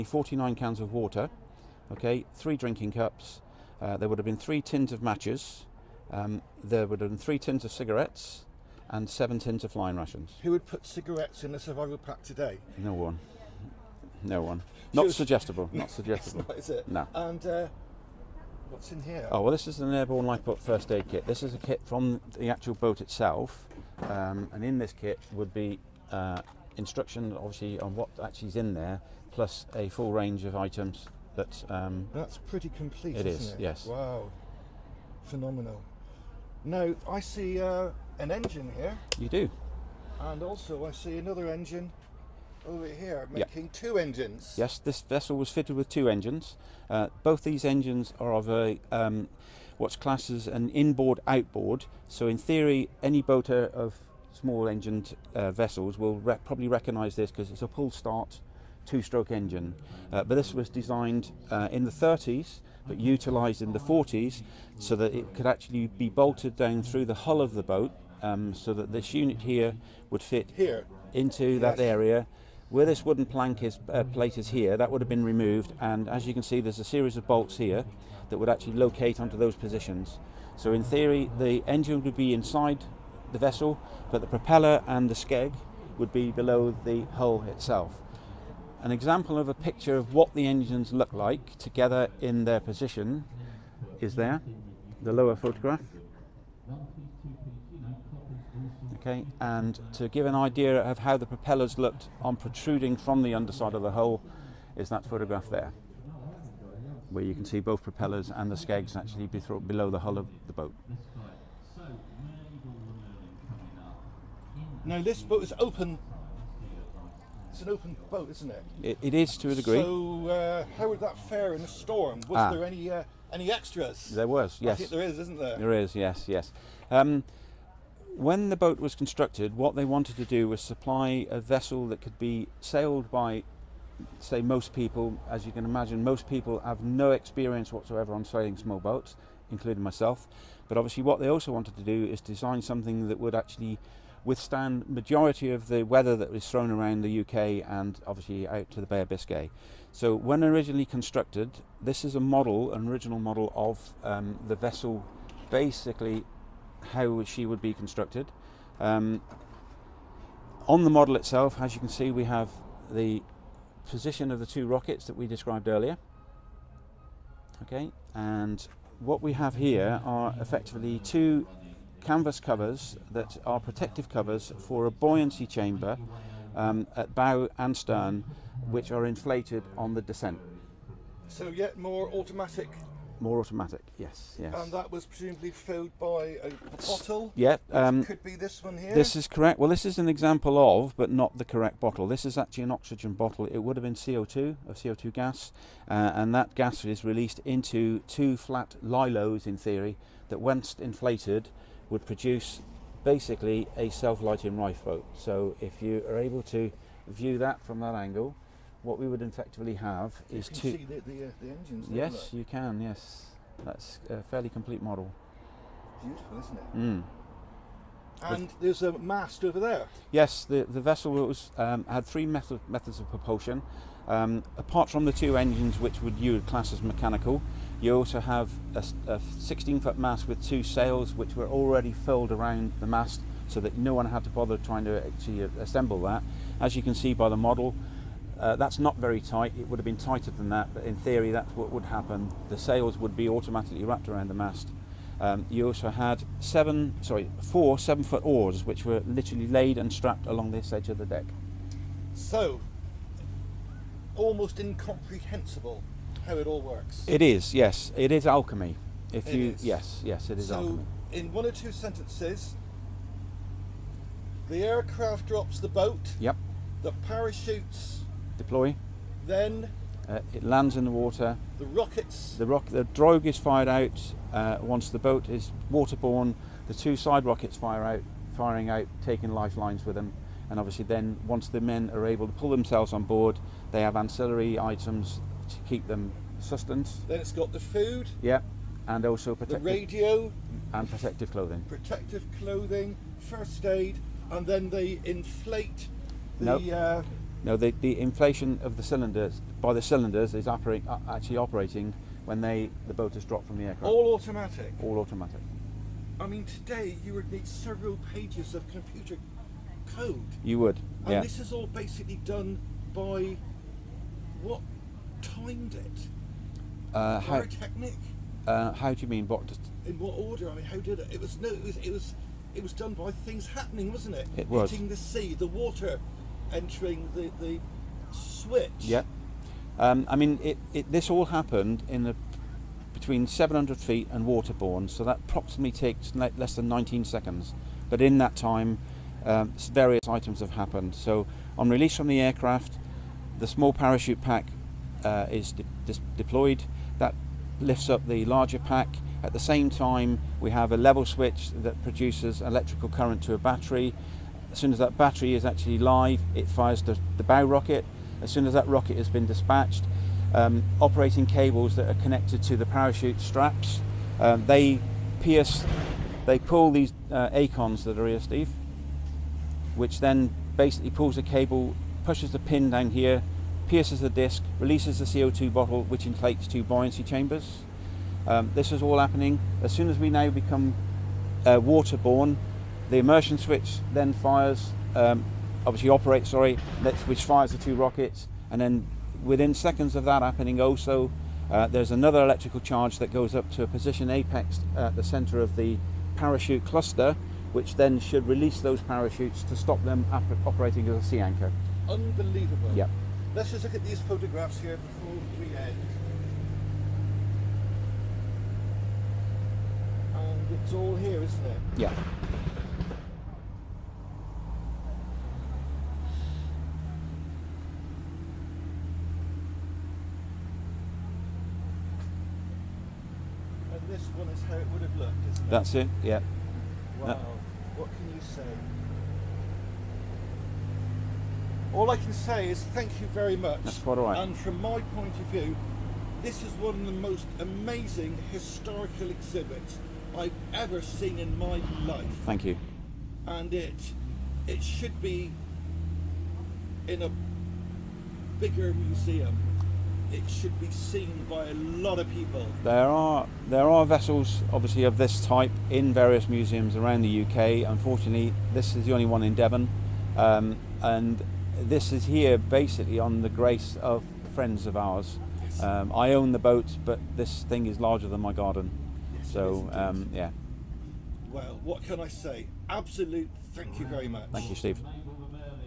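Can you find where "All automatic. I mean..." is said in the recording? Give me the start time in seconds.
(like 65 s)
304 s.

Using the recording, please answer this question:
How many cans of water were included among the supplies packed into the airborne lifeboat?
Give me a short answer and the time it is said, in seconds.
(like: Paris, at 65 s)
49, at 0 s.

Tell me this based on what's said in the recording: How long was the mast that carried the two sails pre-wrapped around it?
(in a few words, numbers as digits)
16 feet.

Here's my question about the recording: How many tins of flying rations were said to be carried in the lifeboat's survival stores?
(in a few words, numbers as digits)
7.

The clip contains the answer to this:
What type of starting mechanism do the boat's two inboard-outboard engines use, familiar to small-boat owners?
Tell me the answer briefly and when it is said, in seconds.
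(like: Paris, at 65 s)
Pull start, at 57 s.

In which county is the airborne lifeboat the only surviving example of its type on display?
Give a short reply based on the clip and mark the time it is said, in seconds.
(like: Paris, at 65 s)
Devon, at 459 s.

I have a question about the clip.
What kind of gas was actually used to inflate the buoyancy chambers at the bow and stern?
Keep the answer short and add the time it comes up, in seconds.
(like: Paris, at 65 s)
CO2, at 194 s.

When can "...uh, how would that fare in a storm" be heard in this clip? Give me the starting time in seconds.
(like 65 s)
120 s.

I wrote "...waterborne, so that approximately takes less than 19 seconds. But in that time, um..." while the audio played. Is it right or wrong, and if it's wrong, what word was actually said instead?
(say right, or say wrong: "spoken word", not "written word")
right.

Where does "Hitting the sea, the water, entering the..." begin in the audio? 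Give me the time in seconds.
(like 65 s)
324 s.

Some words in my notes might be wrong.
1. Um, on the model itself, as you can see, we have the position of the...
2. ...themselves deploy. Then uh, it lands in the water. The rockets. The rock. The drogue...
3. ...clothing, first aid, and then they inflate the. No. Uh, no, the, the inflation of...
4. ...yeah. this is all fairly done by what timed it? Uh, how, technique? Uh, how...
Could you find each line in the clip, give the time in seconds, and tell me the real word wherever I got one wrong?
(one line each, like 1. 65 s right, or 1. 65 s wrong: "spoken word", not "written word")
1. 158 s right
2. 267 s wrong: "parachutes", not "themselves"
3. 292 s right
4. 311 s wrong: "basically", not "fairly".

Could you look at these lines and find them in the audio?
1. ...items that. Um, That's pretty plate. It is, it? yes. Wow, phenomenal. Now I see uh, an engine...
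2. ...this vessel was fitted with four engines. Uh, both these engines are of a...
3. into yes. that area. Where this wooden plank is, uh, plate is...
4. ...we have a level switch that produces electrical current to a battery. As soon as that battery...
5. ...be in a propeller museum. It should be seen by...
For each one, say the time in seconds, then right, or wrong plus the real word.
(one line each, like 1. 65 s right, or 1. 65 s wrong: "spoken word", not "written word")
1. 30 s wrong: "complete", not "plate"
2. 44 s wrong: "two", not "four"
3. 71 s right
4. 350 s right
5. 444 s wrong: "bigger", not "propeller".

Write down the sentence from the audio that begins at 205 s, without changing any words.
So if you are able to view that from that angle, what we would effectively have you is two.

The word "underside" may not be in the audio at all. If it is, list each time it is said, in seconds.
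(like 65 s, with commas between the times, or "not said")
103 s.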